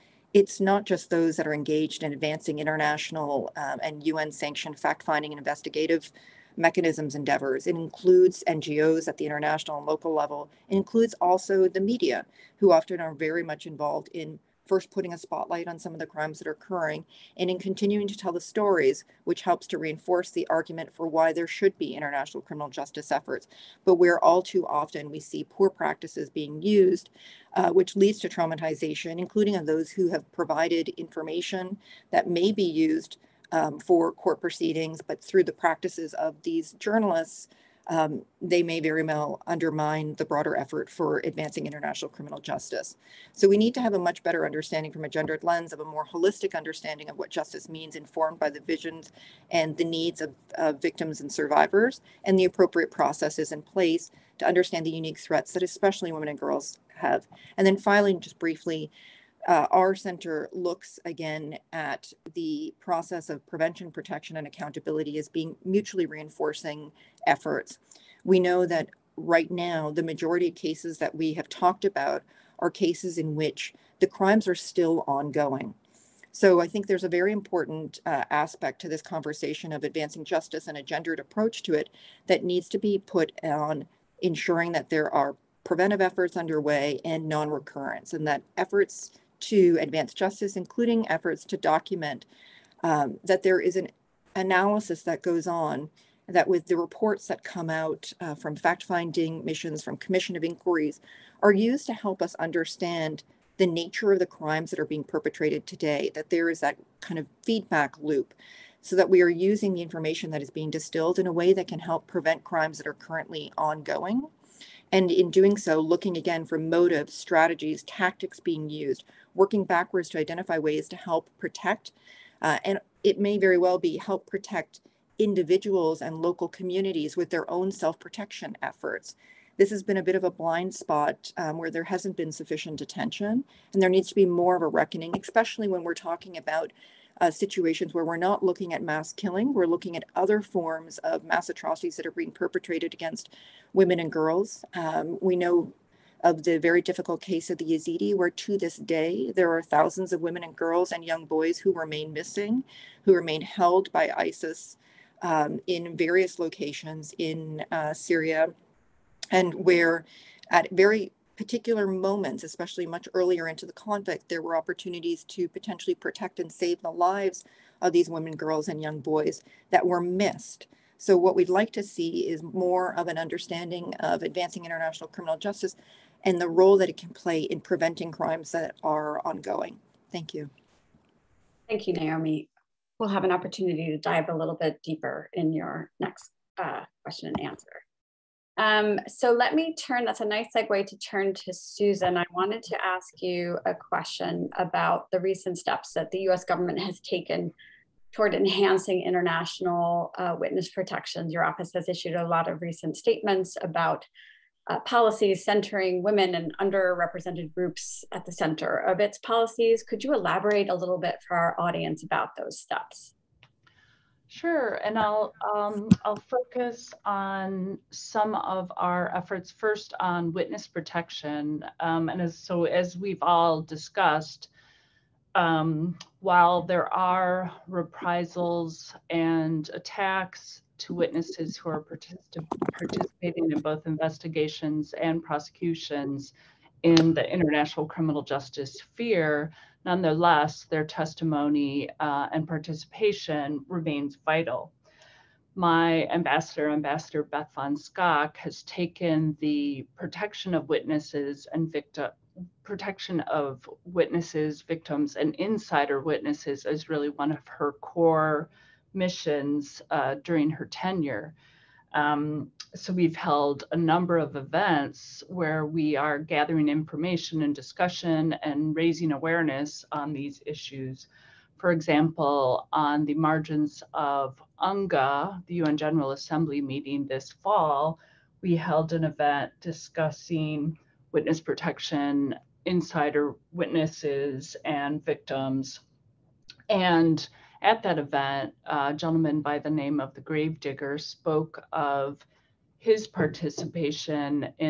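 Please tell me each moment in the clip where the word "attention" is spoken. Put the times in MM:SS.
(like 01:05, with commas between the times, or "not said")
02:12.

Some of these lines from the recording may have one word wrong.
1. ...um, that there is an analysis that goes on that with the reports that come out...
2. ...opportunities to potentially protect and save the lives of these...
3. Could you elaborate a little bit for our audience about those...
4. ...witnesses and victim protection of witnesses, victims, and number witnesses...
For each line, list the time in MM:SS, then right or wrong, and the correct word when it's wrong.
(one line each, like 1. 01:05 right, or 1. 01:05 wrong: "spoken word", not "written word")
1. 01:32 right
2. 02:44 right
3. 03:29 right
4. 04:10 wrong: "insider", not "number".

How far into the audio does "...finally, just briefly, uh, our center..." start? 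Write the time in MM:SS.
00:57.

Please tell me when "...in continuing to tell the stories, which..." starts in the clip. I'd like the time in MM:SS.
00:17.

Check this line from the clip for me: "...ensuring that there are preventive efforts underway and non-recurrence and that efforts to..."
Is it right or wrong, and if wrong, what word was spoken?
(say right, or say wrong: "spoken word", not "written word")
right.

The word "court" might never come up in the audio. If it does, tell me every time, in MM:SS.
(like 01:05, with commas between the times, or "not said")
00:34.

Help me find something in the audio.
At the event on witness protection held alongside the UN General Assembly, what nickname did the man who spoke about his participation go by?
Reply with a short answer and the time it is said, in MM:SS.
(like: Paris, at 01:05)
The Gravedigger, at 04:50.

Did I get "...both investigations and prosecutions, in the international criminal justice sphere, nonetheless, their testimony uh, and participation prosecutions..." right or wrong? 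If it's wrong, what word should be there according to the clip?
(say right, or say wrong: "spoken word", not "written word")
wrong: "remains", not "prosecutions".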